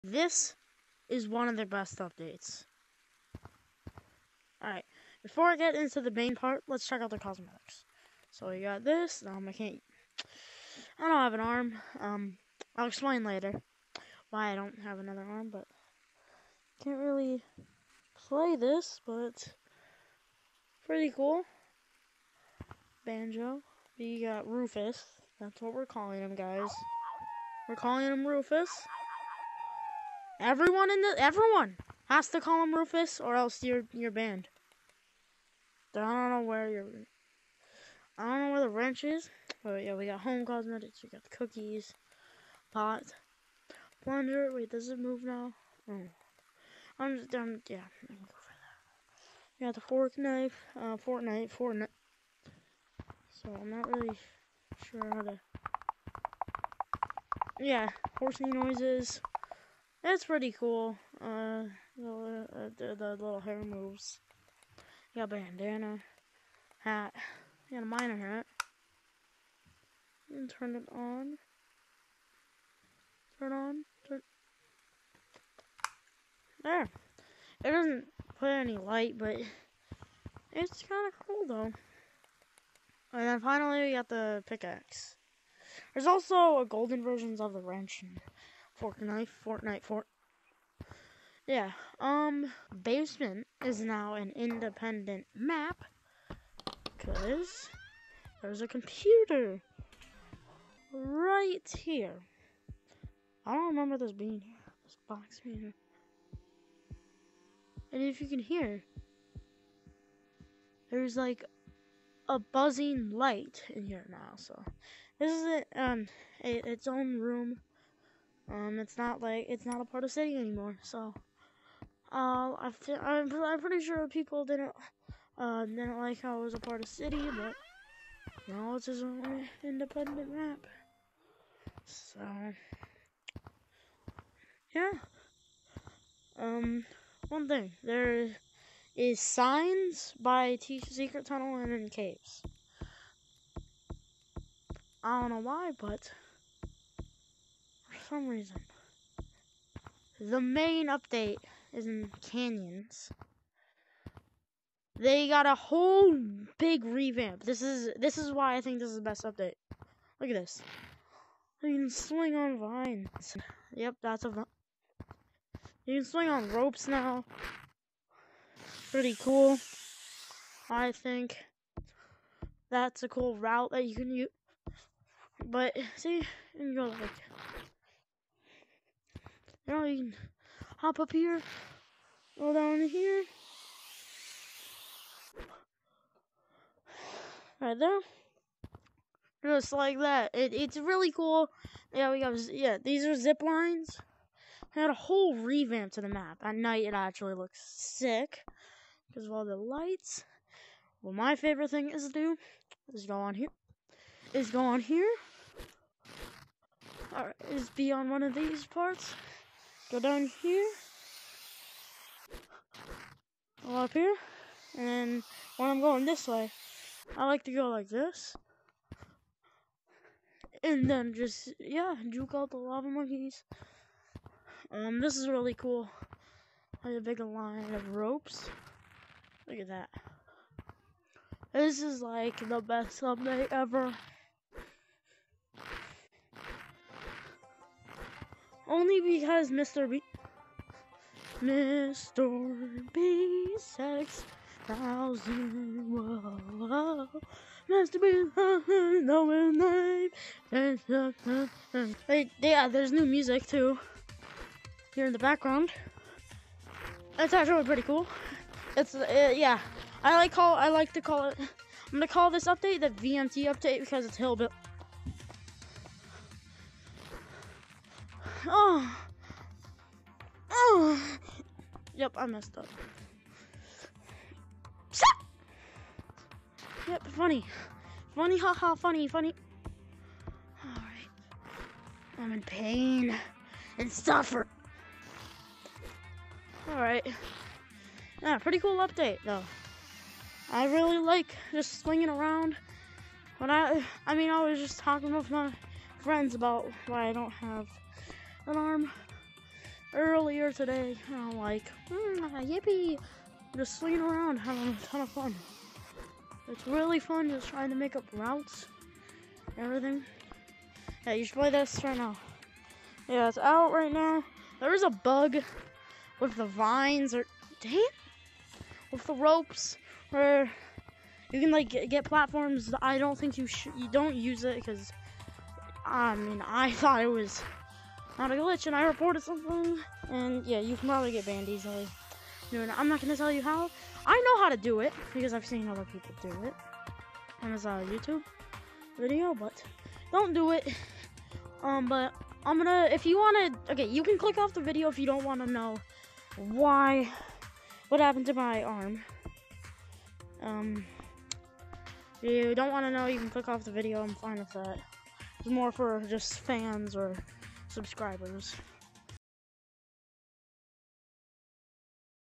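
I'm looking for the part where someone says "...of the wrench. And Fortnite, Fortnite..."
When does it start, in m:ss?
1:27.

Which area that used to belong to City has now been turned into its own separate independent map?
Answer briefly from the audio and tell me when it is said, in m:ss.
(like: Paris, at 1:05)
Basement, at 1:32.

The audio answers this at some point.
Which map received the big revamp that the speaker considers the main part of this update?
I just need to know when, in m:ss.
2:32.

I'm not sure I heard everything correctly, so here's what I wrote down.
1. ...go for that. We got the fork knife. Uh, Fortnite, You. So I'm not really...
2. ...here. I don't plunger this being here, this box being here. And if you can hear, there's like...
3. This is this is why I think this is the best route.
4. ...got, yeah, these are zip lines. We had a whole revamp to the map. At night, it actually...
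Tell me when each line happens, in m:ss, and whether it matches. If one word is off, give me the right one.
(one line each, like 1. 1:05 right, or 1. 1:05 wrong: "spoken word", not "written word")
1. 0:48 wrong: "Fortnite", not "You"
2. 1:41 wrong: "remember", not "plunger"
3. 2:37 wrong: "update", not "route"
4. 3:12 right.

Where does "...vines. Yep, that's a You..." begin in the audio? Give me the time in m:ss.
2:42.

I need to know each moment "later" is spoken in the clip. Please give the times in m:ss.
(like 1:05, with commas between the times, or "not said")
0:13.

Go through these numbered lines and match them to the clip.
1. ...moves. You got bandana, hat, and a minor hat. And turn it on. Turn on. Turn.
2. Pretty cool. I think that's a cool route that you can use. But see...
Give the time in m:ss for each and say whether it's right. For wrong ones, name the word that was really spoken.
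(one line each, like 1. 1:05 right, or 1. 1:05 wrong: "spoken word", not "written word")
1. 1:03 right
2. 2:48 right.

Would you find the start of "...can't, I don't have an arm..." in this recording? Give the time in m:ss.
0:09.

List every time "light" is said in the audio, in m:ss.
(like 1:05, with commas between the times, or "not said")
1:18, 1:53, 3:19.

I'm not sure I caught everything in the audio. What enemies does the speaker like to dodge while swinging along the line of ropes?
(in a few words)
lava monkeys.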